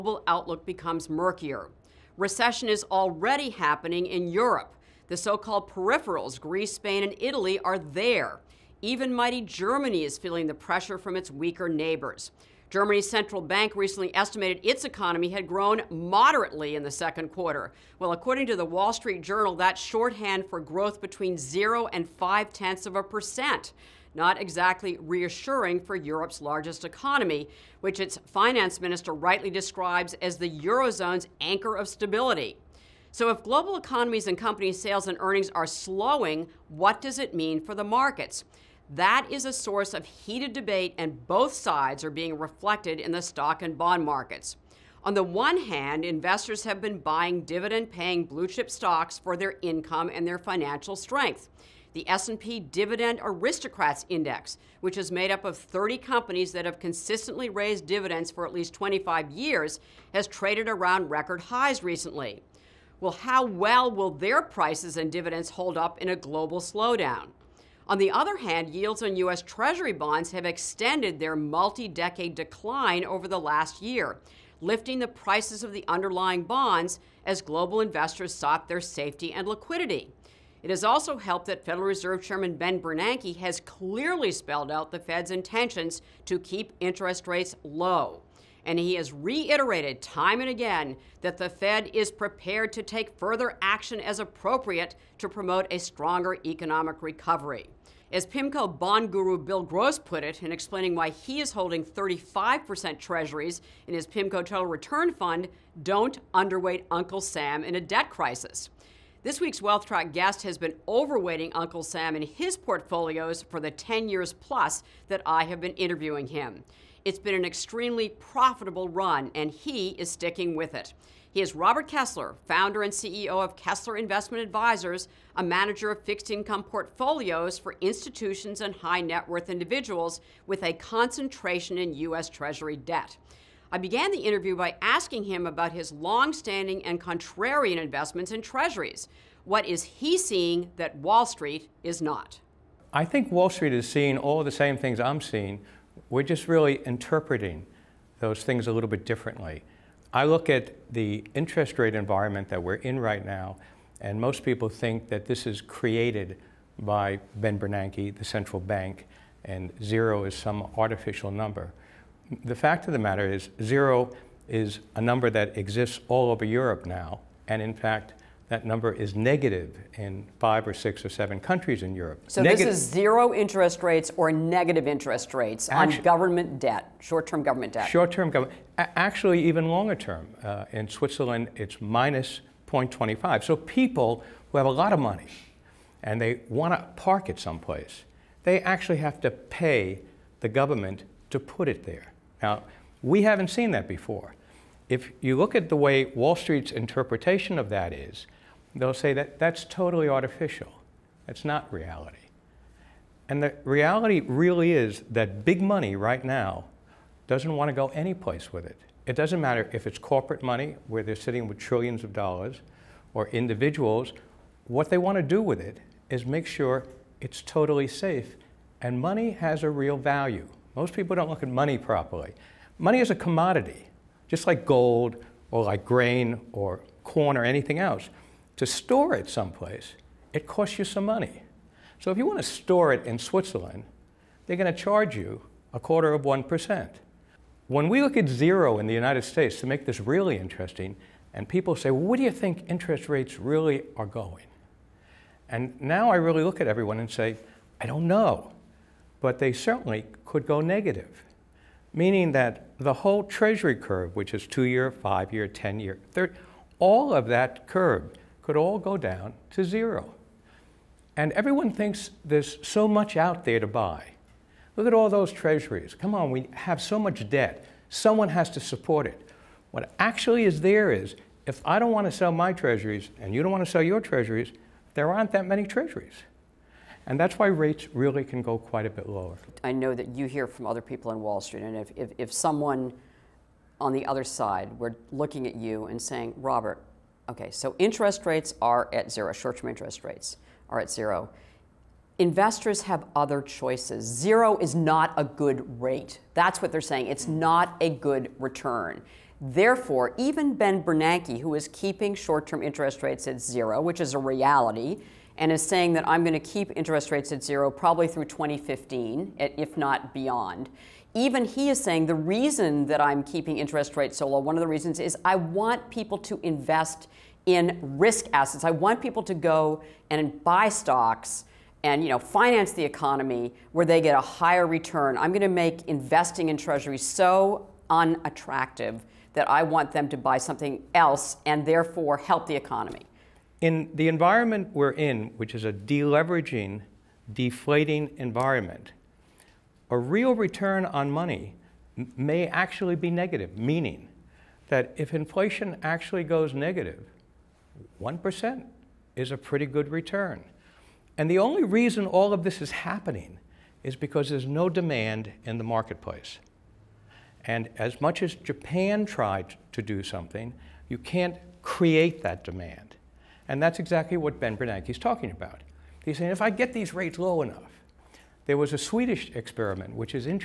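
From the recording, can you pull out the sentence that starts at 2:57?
Short-term government, actually even longer term.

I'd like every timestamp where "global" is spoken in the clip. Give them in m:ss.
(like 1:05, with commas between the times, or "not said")
0:33, 1:06, 1:17.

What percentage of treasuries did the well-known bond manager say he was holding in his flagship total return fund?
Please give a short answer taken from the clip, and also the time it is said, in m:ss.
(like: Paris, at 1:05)
35%, at 1:41.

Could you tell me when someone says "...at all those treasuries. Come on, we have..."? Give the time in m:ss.
4:24.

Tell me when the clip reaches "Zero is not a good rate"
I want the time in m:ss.
4:54.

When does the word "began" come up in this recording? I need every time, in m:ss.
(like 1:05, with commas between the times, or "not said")
2:13.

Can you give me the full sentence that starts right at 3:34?
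What they want to do with it is make sure it's totally safe.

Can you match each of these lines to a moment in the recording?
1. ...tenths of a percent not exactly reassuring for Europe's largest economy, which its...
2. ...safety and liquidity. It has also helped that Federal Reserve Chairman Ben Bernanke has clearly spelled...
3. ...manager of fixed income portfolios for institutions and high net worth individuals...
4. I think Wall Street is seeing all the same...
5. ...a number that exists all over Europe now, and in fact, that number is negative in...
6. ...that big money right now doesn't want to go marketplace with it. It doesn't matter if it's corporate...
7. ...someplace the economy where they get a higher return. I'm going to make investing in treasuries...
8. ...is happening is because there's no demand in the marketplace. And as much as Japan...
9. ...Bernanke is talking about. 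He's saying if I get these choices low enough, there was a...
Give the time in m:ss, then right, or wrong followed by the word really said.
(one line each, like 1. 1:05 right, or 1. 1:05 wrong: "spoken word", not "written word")
1. 0:22 right
2. 1:18 right
3. 2:05 right
4. 2:22 right
5. 2:44 right
6. 3:25 wrong: "anyplace", not "marketplace"
7. 5:22 wrong: "finance", not "someplace"
8. 5:52 right
9. 6:04 wrong: "rates", not "choices".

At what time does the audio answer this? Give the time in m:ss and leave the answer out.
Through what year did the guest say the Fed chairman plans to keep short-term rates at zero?
5:08.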